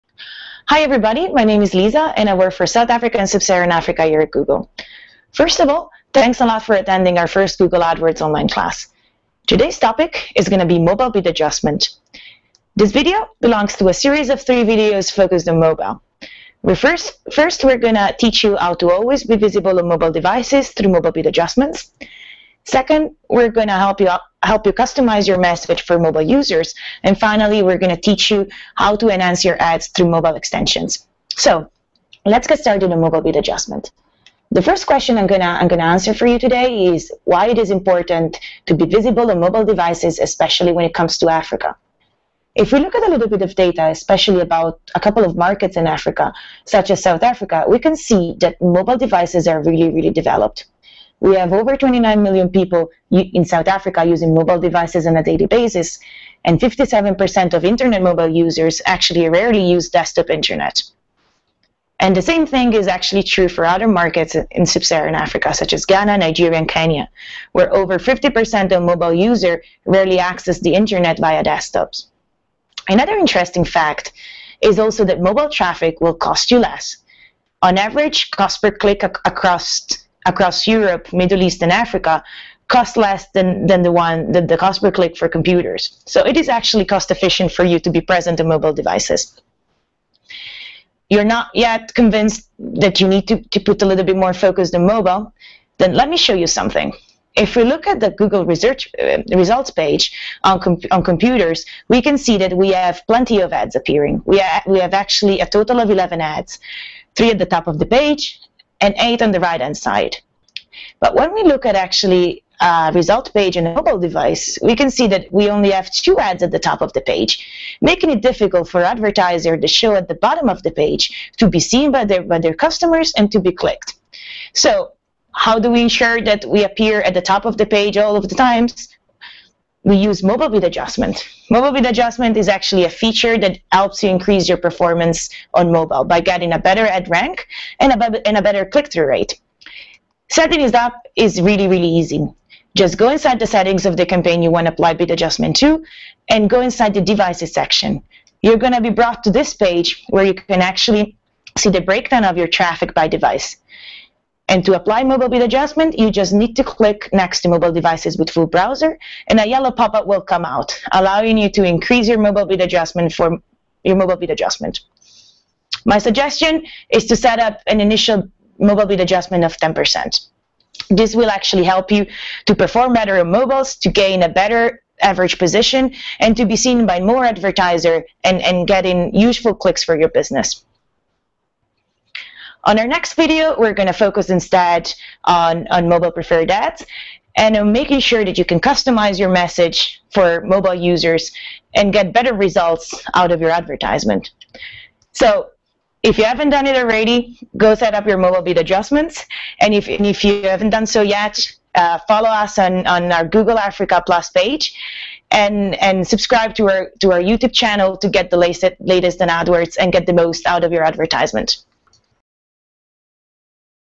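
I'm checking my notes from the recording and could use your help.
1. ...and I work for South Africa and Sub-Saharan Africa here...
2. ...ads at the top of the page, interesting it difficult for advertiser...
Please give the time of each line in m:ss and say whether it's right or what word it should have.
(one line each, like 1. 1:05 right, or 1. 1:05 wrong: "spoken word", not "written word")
1. 0:02 right
2. 1:56 wrong: "making", not "interesting".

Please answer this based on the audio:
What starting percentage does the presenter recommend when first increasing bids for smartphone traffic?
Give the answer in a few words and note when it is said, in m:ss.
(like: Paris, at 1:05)
10%, at 2:49.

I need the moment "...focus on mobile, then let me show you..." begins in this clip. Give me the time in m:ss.
1:34.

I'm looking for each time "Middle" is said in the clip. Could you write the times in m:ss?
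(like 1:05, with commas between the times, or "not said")
1:21.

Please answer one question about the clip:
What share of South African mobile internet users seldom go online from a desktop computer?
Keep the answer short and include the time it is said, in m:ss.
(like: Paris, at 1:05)
57%, at 0:56.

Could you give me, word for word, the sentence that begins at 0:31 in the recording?
So, let's get started on mobile bid adjustment.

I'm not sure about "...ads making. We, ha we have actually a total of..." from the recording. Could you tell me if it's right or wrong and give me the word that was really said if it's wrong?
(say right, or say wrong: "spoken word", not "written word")
wrong: "appearing", not "making".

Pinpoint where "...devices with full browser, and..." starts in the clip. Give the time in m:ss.
2:37.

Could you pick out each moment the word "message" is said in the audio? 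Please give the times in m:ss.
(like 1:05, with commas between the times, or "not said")
0:25, 3:09.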